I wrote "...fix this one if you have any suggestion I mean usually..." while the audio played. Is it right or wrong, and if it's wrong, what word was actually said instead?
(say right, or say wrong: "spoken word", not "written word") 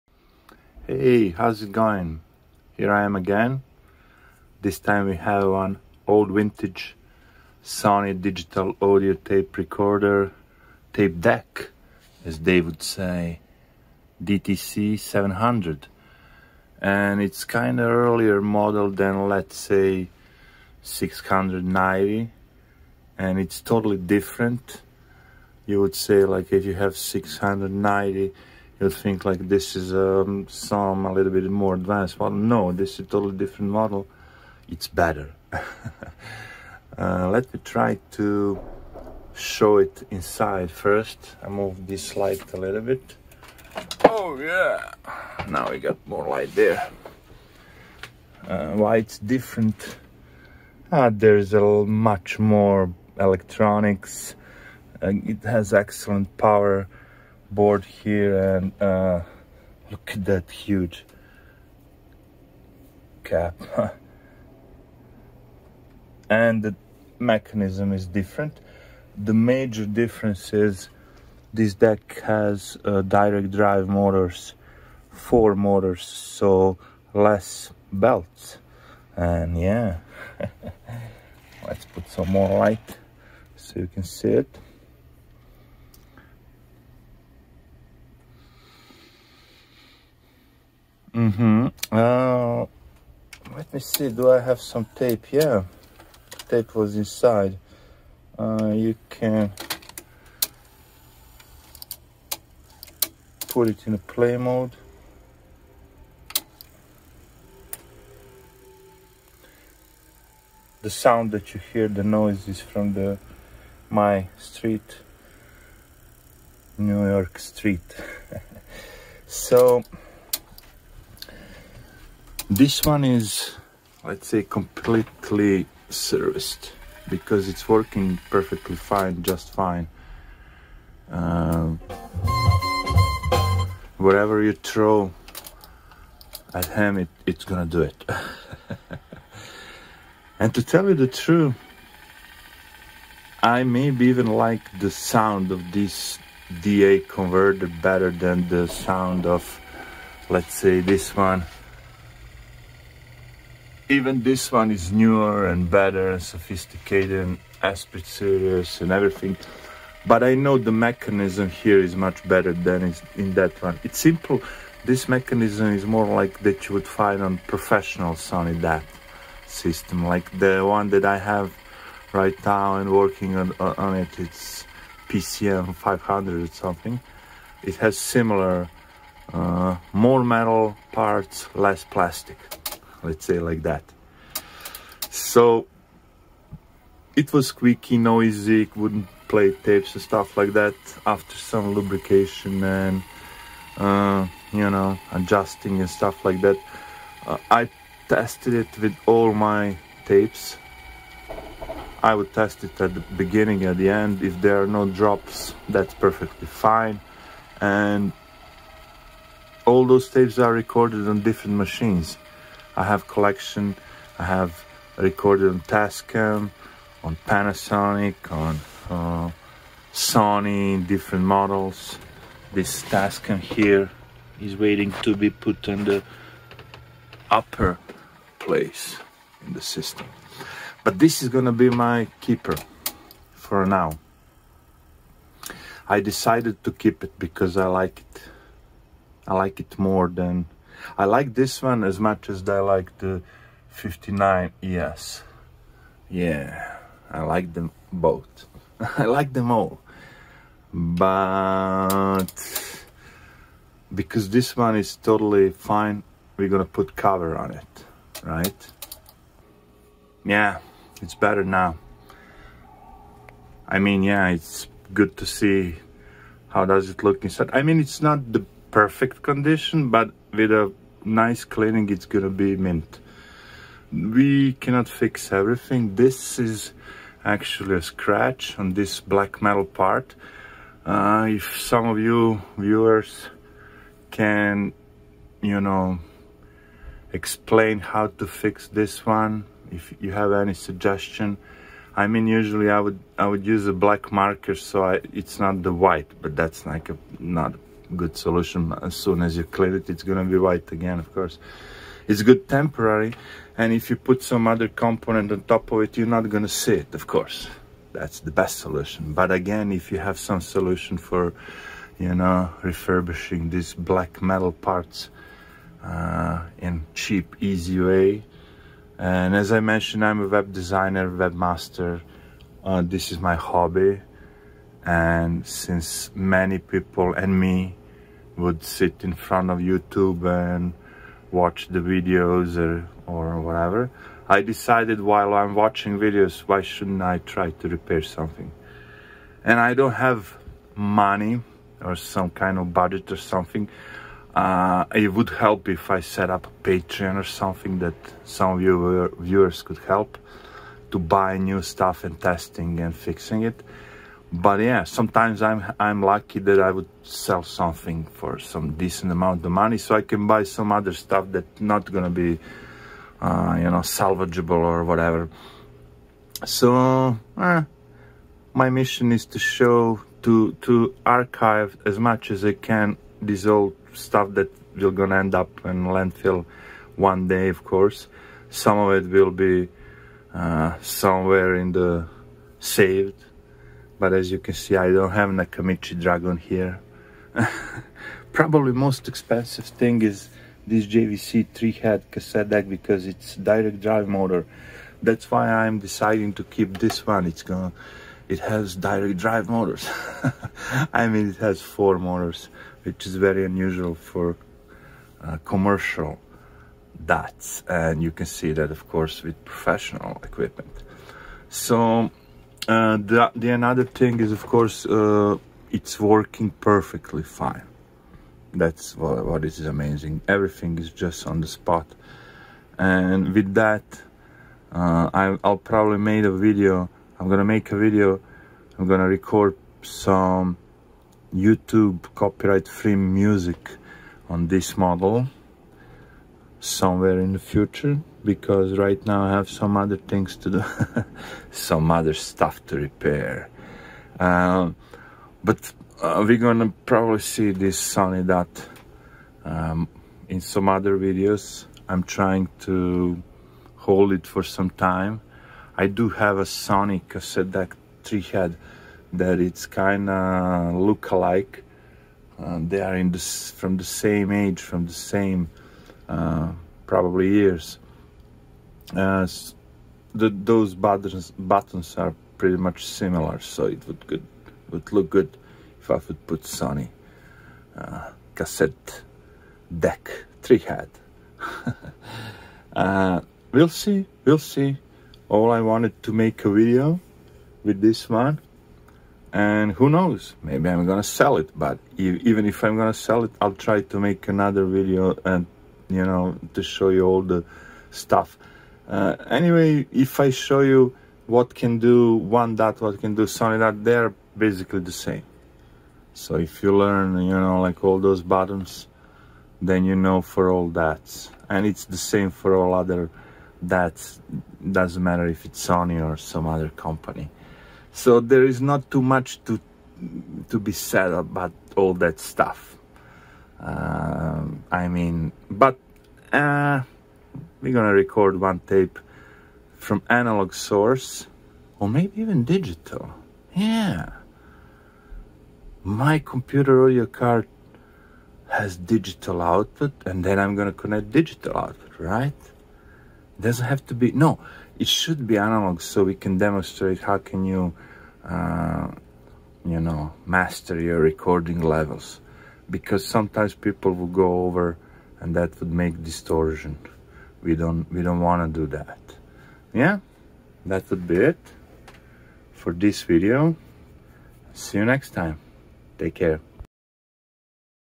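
right.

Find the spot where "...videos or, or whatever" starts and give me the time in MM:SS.
05:31.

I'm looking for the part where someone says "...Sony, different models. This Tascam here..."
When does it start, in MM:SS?
03:39.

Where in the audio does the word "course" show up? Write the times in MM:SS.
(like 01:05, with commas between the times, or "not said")
05:01, 05:07, 06:17, 06:48, 06:54.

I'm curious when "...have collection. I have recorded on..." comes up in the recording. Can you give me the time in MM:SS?
03:32.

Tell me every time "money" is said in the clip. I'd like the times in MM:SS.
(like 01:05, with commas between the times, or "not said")
05:40, 05:59.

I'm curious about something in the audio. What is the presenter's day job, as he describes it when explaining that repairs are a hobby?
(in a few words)
web designer.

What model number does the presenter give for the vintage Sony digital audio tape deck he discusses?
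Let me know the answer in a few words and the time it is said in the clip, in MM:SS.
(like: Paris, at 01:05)
DTC 700, at 00:14.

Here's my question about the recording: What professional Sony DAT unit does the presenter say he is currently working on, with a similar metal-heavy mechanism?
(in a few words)
PCM 500.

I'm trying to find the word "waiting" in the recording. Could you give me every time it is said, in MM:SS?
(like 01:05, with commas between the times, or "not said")
03:44.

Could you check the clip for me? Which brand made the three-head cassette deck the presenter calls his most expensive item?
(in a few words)
JVC.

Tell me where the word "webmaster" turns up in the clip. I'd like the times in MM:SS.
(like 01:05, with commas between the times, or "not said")
05:21.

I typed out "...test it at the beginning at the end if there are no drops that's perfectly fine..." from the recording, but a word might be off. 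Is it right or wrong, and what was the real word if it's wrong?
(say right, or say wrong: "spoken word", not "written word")
right.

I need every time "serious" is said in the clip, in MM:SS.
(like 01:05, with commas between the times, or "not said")
02:38.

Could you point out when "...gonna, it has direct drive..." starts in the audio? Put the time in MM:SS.
06:37.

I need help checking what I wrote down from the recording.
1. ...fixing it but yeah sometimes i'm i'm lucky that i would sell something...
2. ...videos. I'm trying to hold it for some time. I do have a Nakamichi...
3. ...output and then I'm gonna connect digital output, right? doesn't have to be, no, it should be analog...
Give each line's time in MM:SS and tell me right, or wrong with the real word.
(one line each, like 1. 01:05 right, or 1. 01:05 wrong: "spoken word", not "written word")
1. 05:52 right
2. 07:30 wrong: "Sony", not "Nakamichi"
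3. 08:59 right.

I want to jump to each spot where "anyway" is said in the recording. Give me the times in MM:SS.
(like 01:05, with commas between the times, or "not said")
08:19.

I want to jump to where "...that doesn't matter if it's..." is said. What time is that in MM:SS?
08:33.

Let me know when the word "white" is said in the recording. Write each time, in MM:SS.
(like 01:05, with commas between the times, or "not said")
04:55, 05:00.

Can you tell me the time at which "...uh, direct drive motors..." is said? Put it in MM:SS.
01:12.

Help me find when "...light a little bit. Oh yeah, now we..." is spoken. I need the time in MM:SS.
00:42.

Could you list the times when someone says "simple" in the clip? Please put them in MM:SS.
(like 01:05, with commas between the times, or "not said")
02:43.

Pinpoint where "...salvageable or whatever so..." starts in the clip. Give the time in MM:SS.
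06:03.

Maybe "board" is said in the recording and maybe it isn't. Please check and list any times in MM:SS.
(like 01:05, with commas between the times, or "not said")
00:57.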